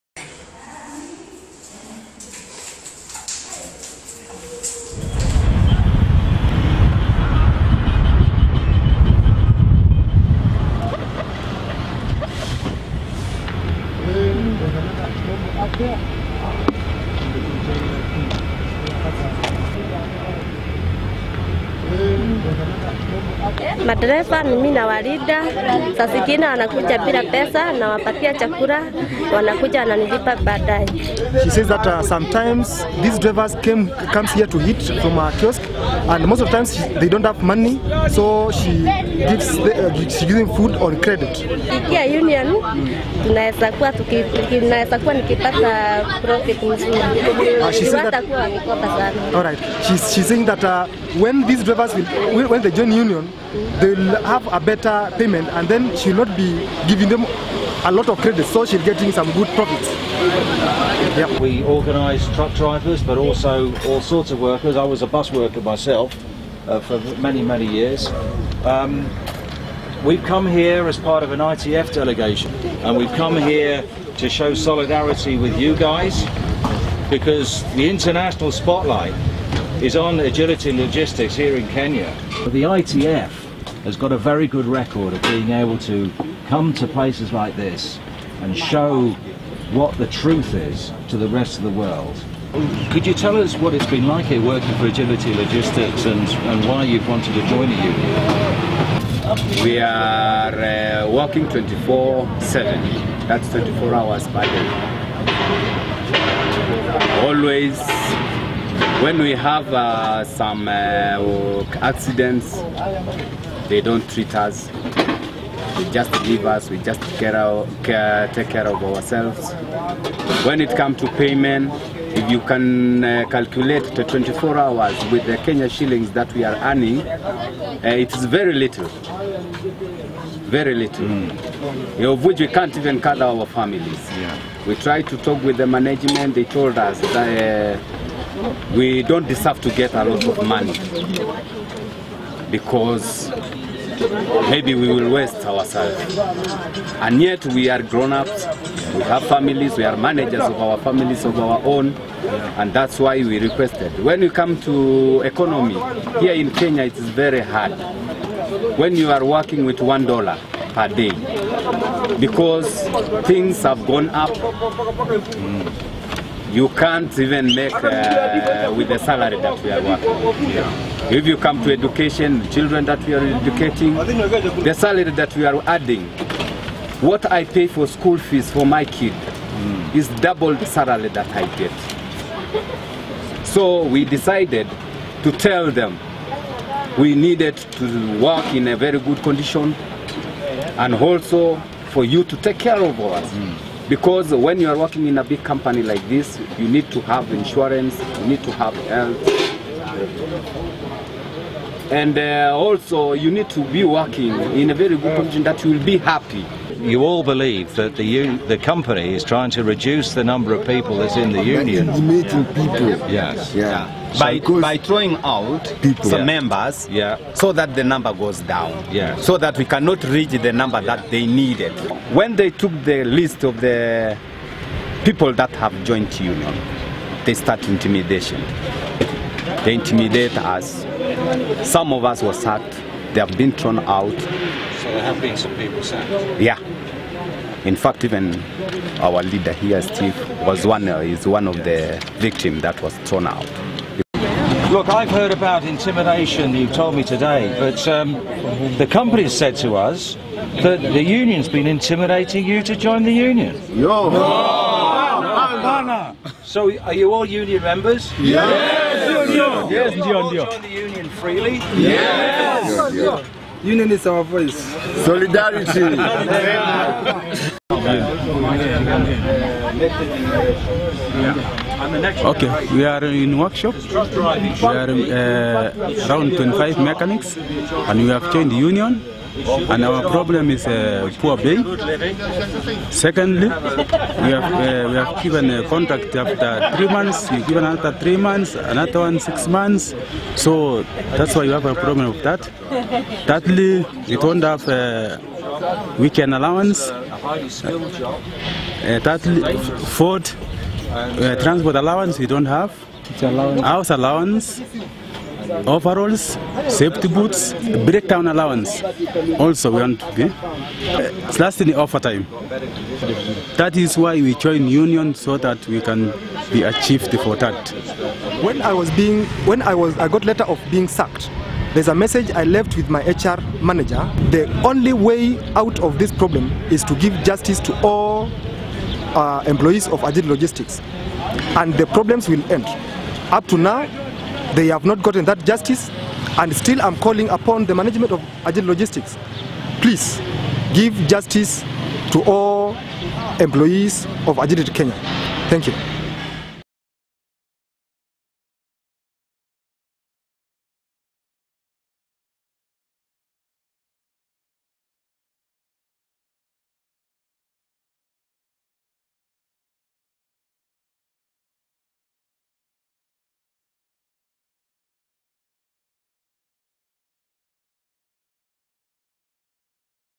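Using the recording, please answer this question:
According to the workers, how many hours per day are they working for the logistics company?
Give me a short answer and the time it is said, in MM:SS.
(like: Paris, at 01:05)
24, at 01:43.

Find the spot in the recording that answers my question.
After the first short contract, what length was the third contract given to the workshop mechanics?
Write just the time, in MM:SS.
04:49.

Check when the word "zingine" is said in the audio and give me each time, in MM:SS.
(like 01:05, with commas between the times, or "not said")
00:26.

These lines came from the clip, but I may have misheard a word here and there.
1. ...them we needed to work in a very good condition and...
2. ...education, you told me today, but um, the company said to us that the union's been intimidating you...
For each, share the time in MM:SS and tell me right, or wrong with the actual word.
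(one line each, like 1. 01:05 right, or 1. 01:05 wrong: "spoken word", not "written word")
1. 03:05 right
2. 04:05 wrong: "intimidation", not "education".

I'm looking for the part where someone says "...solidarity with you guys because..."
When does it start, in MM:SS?
01:14.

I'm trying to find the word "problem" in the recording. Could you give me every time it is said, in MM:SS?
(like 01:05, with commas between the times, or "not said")
04:40, 04:51, 05:26, 05:31.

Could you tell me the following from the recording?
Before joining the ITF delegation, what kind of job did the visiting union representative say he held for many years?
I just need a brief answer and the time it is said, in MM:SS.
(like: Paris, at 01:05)
bus worker, at 01:05.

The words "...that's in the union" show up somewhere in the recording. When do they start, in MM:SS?
03:30.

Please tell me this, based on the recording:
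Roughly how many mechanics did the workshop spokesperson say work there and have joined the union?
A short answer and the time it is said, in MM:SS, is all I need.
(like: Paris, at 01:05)
25, at 04:36.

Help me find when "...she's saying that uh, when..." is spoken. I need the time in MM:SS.
00:50.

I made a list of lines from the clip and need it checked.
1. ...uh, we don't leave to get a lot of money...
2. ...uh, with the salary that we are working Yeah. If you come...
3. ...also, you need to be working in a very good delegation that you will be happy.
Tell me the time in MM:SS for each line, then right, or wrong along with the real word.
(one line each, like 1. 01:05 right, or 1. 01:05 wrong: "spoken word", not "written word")
1. 02:17 wrong: "deserve", not "leave"
2. 02:47 right
3. 03:22 wrong: "position", not "delegation".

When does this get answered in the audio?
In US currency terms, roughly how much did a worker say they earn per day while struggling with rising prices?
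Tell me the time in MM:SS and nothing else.
02:39.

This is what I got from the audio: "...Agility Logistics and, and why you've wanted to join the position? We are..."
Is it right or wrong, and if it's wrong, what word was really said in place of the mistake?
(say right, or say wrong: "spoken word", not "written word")
wrong: "union", not "position".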